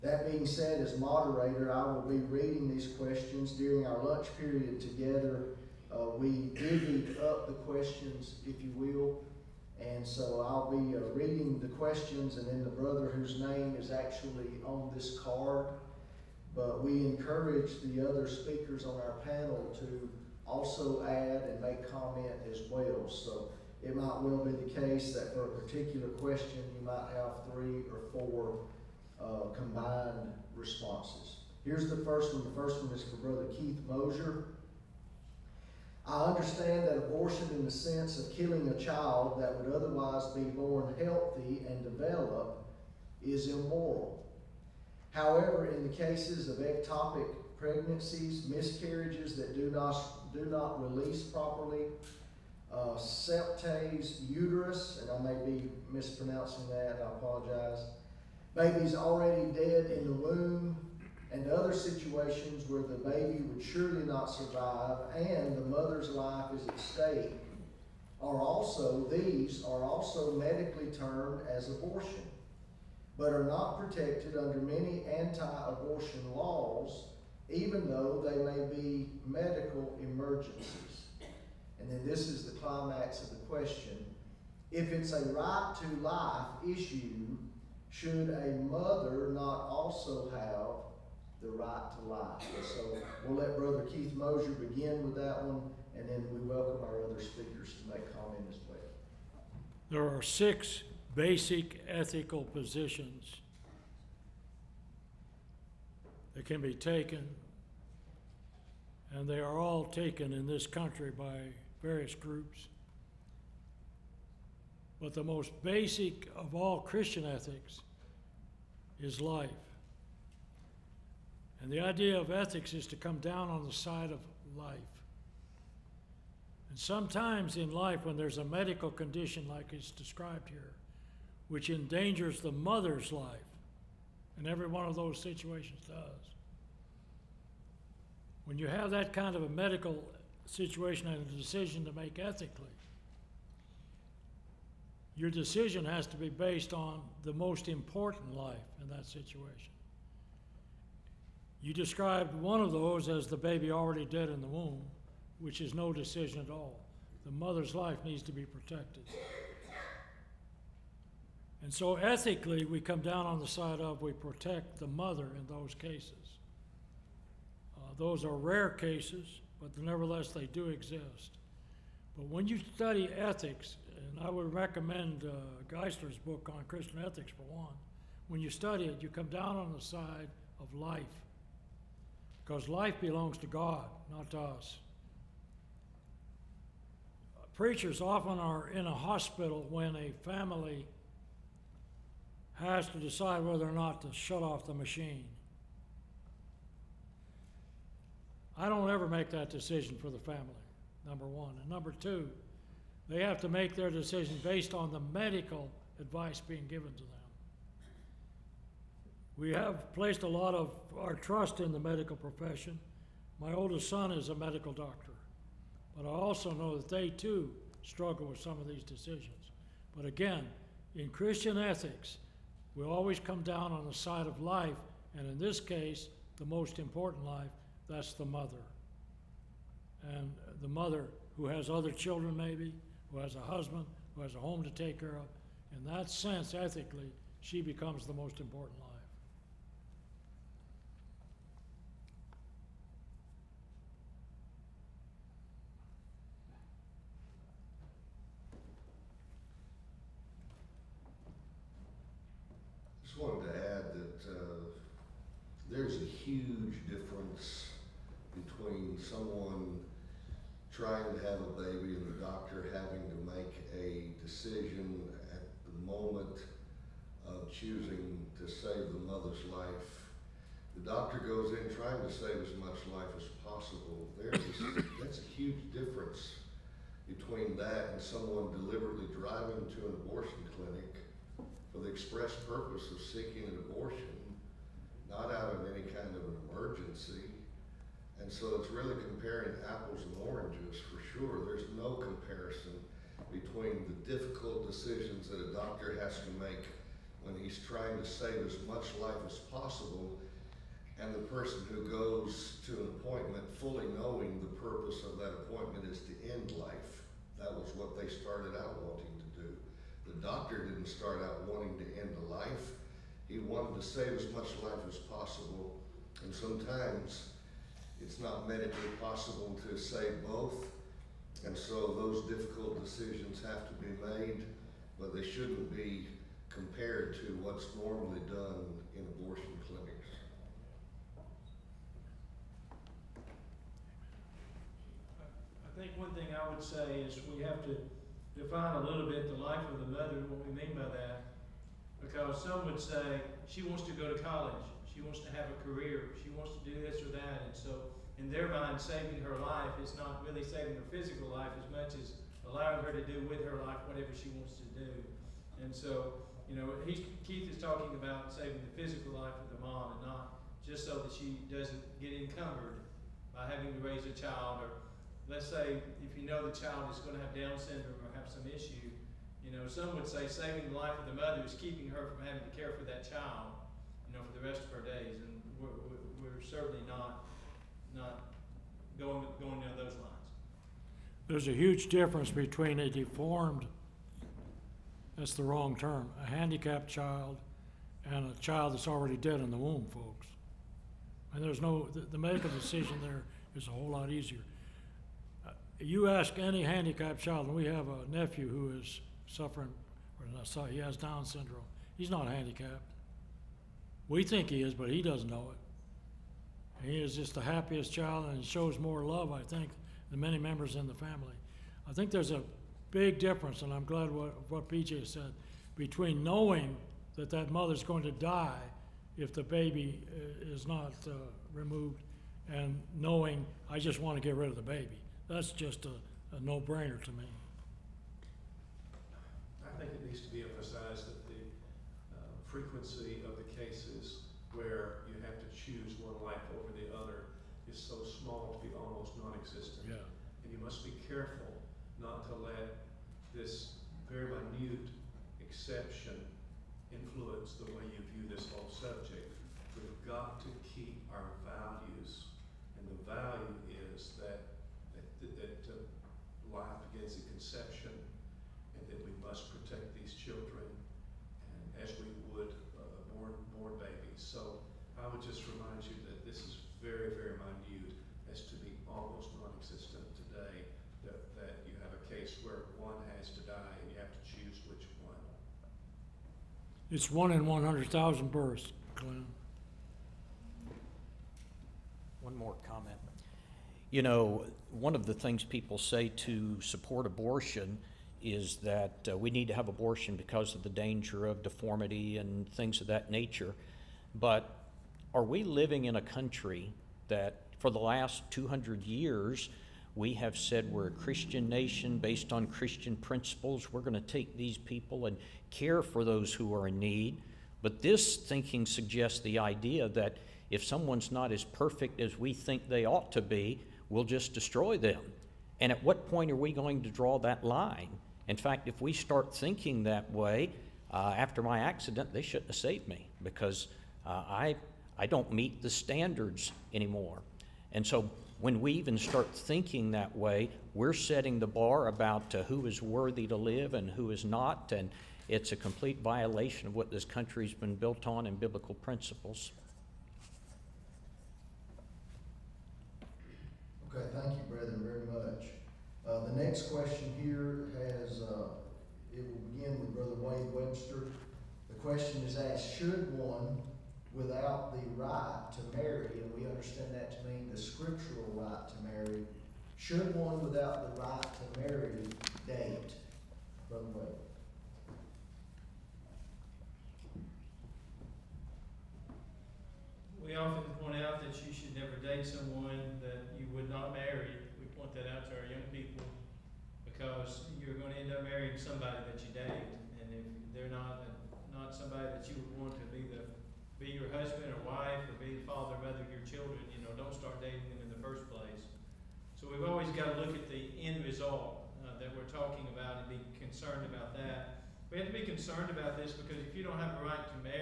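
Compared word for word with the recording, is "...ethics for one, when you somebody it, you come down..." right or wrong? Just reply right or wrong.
wrong.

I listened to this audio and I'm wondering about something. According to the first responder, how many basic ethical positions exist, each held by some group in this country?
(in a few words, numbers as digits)
6.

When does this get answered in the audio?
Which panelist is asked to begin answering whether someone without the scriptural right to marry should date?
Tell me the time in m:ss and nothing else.
9:10.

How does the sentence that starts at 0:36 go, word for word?
I understand that abortion in the sense of killing a child that would otherwise be born healthy and develop is immoral.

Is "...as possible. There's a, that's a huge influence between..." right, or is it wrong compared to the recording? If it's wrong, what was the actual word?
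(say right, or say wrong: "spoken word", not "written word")
wrong: "difference", not "influence".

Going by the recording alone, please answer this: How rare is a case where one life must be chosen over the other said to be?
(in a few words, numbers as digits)
1 in 100,000.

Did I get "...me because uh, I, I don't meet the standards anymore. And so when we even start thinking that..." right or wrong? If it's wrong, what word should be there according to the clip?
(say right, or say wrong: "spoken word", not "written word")
right.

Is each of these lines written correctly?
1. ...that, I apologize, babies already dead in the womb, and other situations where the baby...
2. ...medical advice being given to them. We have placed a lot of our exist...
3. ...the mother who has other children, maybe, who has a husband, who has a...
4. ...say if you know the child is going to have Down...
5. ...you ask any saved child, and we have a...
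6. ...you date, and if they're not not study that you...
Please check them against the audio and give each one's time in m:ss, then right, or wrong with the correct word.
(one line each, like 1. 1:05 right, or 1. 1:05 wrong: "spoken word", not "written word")
1. 0:56 right
2. 3:25 wrong: "trust", not "exist"
3. 3:50 right
4. 6:05 right
5. 6:35 wrong: "handicapped", not "saved"
6. 9:39 wrong: "somebody", not "study".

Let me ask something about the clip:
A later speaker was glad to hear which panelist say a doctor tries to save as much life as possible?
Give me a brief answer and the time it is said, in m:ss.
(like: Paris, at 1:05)
BJ, at 6:54.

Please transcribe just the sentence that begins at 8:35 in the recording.
And at what point are we going to draw that line?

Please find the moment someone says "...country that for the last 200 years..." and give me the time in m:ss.
8:16.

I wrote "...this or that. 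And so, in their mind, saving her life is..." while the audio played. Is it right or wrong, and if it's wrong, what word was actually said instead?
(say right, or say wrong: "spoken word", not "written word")
right.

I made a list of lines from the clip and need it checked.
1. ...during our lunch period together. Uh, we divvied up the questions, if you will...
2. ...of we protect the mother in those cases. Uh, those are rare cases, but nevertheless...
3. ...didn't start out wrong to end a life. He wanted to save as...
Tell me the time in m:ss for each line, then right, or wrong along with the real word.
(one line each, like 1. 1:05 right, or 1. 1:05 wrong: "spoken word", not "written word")
1. 0:03 right
2. 2:43 right
3. 5:10 wrong: "wanting", not "wrong".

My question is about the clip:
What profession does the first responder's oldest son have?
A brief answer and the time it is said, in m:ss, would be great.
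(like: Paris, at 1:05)
Medical doctor, at 3:34.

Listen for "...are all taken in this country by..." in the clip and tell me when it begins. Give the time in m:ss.
1:49.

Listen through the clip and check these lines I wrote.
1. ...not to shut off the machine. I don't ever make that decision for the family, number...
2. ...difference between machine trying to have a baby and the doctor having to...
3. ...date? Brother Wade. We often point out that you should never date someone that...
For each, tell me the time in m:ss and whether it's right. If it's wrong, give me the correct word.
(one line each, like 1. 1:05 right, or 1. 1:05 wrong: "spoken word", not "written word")
1. 3:13 right
2. 4:16 wrong: "someone", not "machine"
3. 9:22 right.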